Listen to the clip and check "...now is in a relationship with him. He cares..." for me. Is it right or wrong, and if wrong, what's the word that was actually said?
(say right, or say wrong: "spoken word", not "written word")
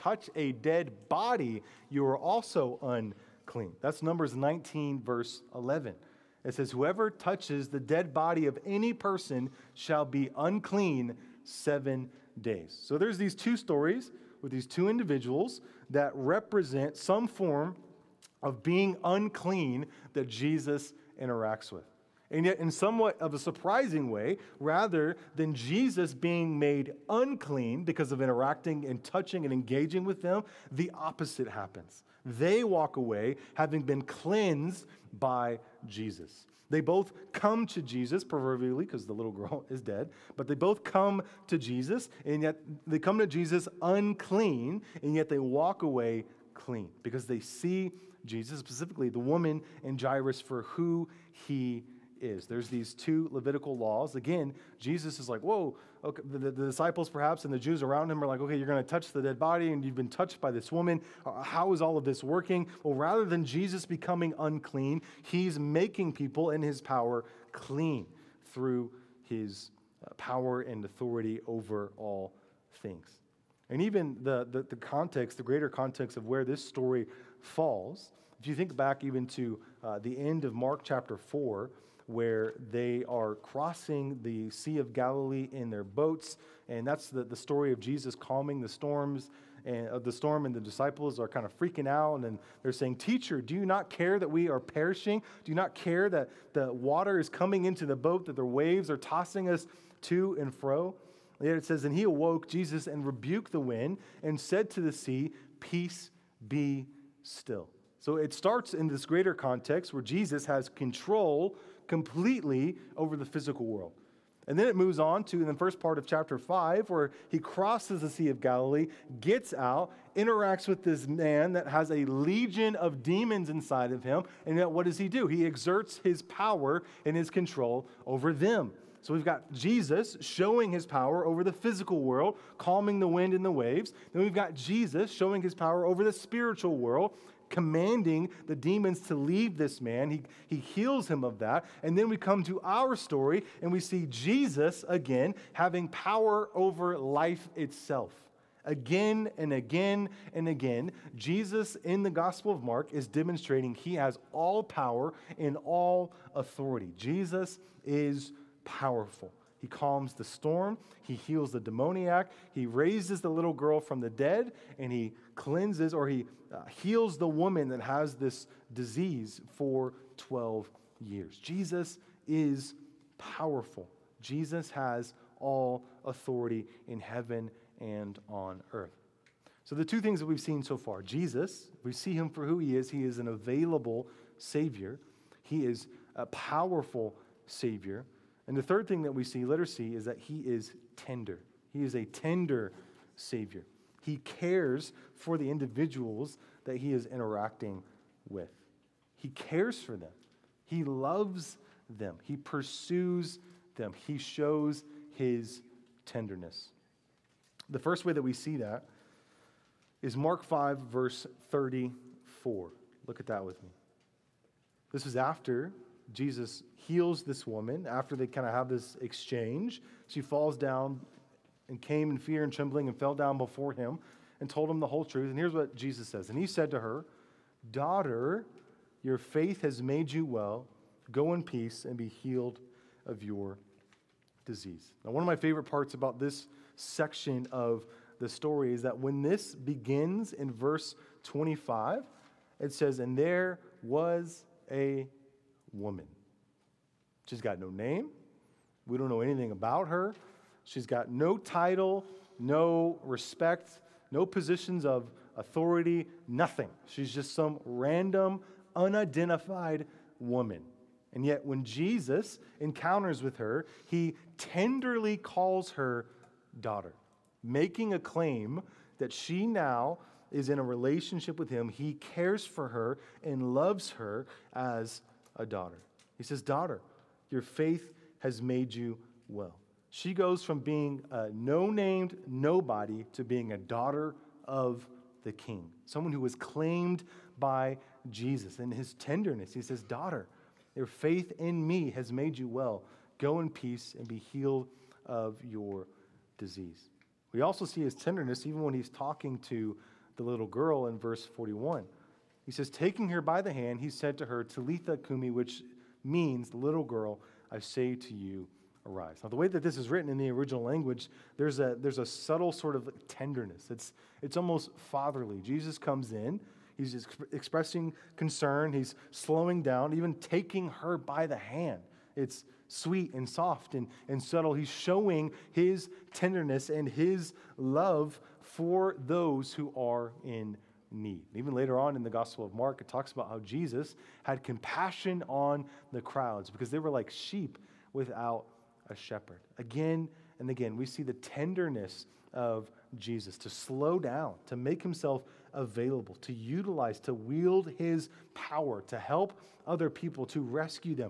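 right.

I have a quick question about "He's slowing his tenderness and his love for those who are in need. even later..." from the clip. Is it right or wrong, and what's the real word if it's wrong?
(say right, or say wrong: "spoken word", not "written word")
wrong: "showing", not "slowing".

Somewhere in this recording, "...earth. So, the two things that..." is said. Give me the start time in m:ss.
2:58.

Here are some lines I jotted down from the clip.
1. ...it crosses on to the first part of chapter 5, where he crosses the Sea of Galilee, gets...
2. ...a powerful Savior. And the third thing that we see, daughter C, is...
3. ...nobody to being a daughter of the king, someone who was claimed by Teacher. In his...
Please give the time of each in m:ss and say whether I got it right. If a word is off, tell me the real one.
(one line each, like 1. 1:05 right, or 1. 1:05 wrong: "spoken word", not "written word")
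1. 1:54 wrong: "moves", not "crosses"
2. 3:06 wrong: "letter", not "daughter"
3. 4:42 wrong: "Jesus", not "Teacher".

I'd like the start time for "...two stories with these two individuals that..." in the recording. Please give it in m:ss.
0:13.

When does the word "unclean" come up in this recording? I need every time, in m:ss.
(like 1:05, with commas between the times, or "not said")
0:02, 0:10, 0:19, 0:27, 0:43, 1:04.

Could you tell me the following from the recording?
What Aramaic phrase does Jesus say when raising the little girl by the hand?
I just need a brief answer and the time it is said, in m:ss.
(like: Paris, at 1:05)
Talitha Kumi, at 5:04.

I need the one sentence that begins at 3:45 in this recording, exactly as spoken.
And here's what Jesus says And he said to her, Daughter, your faith has made you well.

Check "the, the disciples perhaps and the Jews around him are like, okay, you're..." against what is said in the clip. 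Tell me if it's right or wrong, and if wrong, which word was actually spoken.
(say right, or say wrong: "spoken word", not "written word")
right.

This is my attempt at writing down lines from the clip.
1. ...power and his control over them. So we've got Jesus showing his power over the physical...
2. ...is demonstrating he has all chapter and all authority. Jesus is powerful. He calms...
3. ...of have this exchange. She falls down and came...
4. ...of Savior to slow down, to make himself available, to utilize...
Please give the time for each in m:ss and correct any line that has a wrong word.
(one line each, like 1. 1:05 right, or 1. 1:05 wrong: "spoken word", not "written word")
1. 2:06 right
2. 2:32 wrong: "power", not "chapter"
3. 3:38 right
4. 5:42 wrong: "Jesus", not "Savior".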